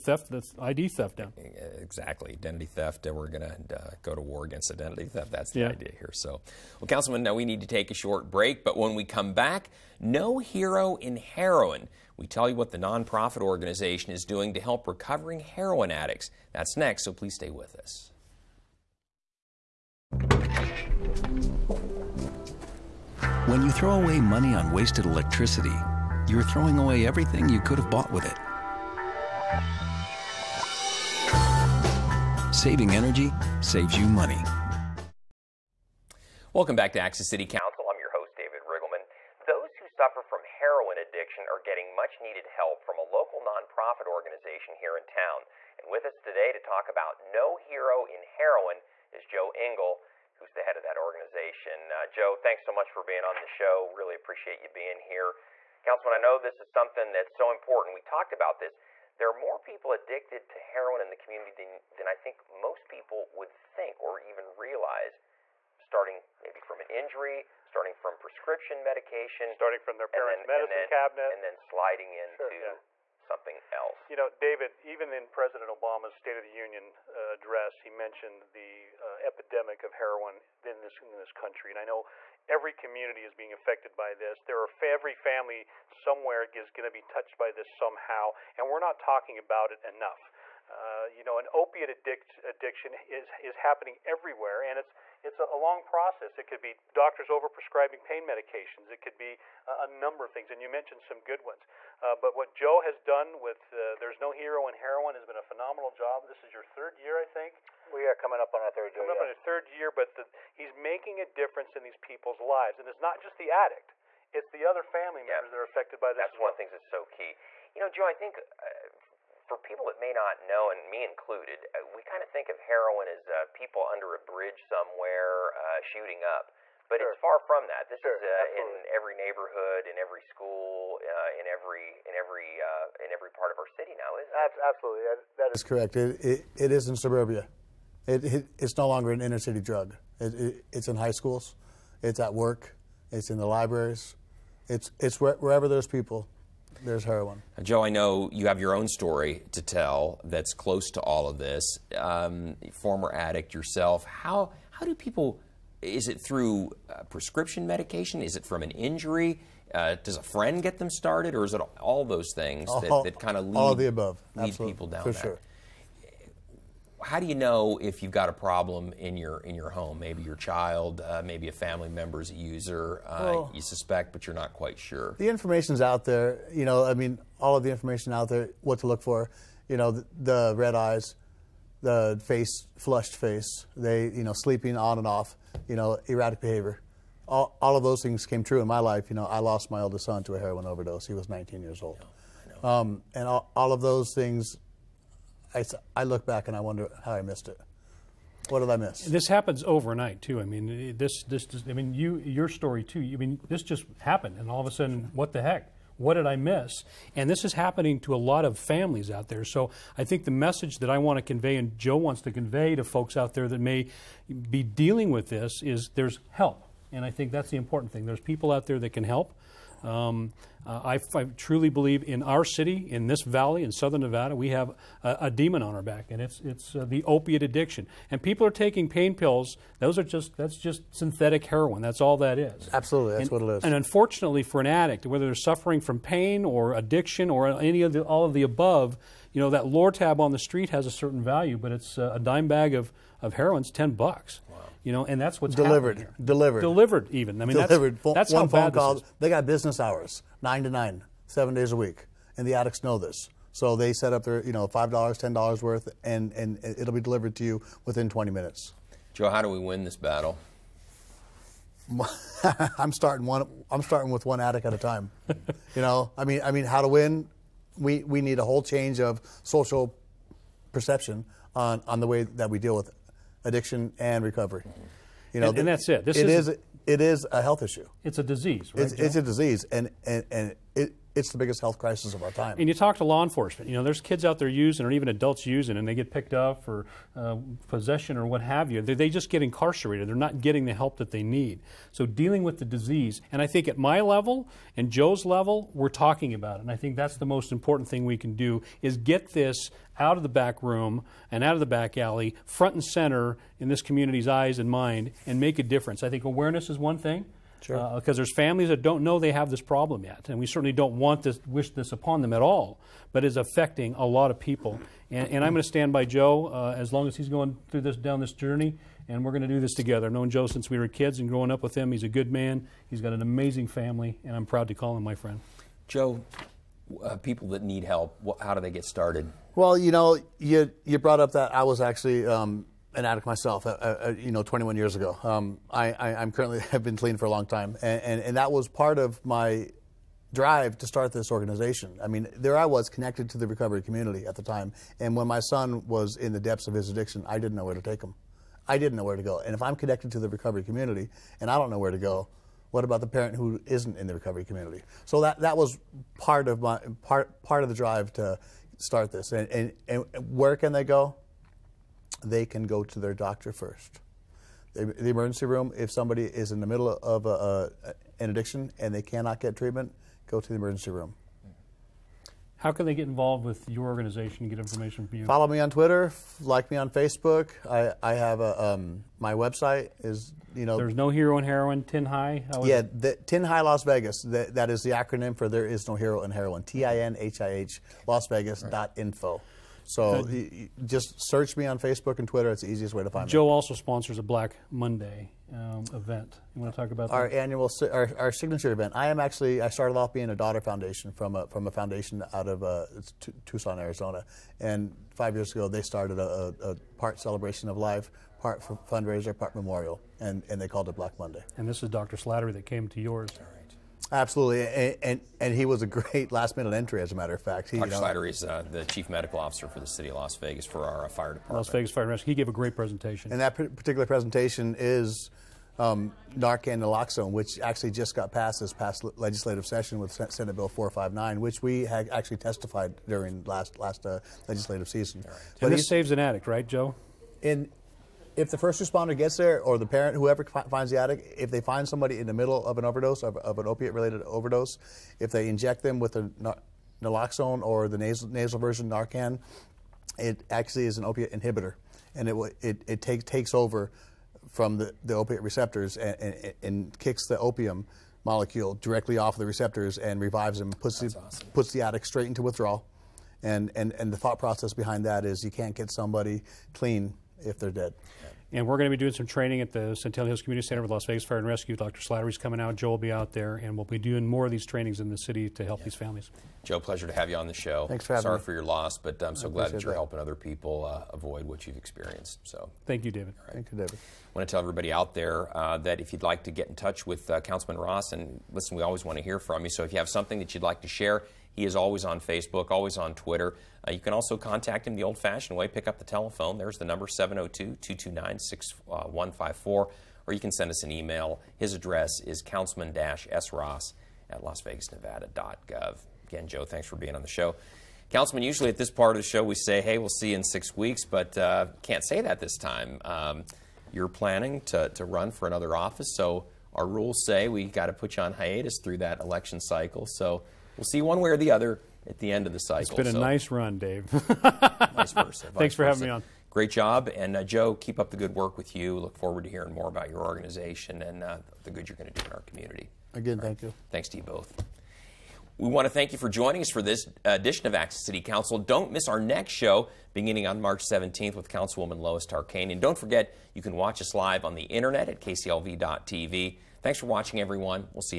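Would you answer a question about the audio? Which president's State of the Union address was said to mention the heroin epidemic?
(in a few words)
President Obama.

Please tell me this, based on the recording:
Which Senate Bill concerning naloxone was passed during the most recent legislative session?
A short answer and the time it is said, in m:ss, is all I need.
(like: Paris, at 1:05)
Senate Bill 459, at 7:10.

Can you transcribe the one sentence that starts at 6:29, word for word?
So he, just search me on Facebook and Twitter.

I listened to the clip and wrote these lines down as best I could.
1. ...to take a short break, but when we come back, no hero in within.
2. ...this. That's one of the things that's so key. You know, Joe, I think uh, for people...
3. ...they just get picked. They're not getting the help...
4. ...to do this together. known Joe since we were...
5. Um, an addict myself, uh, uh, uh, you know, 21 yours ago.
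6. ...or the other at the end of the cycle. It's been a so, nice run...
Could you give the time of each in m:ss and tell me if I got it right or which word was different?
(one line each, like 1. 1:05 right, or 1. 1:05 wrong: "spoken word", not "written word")
1. 0:07 wrong: "heroin", not "within"
2. 1:56 right
3. 4:48 wrong: "incarcerated", not "picked"
4. 5:19 right
5. 5:32 wrong: "years", not "yours"
6. 8:41 right.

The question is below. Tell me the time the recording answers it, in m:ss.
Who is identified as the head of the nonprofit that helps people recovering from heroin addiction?
0:49.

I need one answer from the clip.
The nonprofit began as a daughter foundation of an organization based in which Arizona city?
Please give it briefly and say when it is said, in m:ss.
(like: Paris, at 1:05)
Tucson, at 6:43.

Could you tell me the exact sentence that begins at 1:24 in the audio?
There are every family somewhere is going to be touched by this somehow, and we're not talking about it enough.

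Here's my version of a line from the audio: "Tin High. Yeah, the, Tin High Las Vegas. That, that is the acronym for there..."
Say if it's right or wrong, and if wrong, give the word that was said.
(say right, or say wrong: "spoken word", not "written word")
right.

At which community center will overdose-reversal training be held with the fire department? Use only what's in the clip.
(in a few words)
Centennial Hills Community Center.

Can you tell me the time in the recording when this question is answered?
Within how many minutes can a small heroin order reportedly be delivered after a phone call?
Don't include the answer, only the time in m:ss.
4:18.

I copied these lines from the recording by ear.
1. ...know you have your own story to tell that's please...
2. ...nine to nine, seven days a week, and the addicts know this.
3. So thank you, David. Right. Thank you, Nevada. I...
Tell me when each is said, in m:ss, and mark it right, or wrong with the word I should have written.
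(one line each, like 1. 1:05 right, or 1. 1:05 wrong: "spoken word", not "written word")
1. 2:27 wrong: "close", not "please"
2. 4:10 right
3. 8:02 wrong: "David", not "Nevada".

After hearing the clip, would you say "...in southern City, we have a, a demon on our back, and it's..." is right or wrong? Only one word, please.
wrong.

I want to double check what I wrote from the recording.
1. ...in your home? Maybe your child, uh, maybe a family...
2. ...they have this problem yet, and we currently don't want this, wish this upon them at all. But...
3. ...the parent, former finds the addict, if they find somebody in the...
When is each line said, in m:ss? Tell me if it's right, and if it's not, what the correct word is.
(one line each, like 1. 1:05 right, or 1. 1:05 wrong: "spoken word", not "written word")
1. 2:49 right
2. 5:09 wrong: "certainly", not "currently"
3. 7:19 wrong: "whoever", not "former".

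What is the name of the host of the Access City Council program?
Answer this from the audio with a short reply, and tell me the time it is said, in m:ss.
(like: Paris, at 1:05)
David Riggleman, at 0:38.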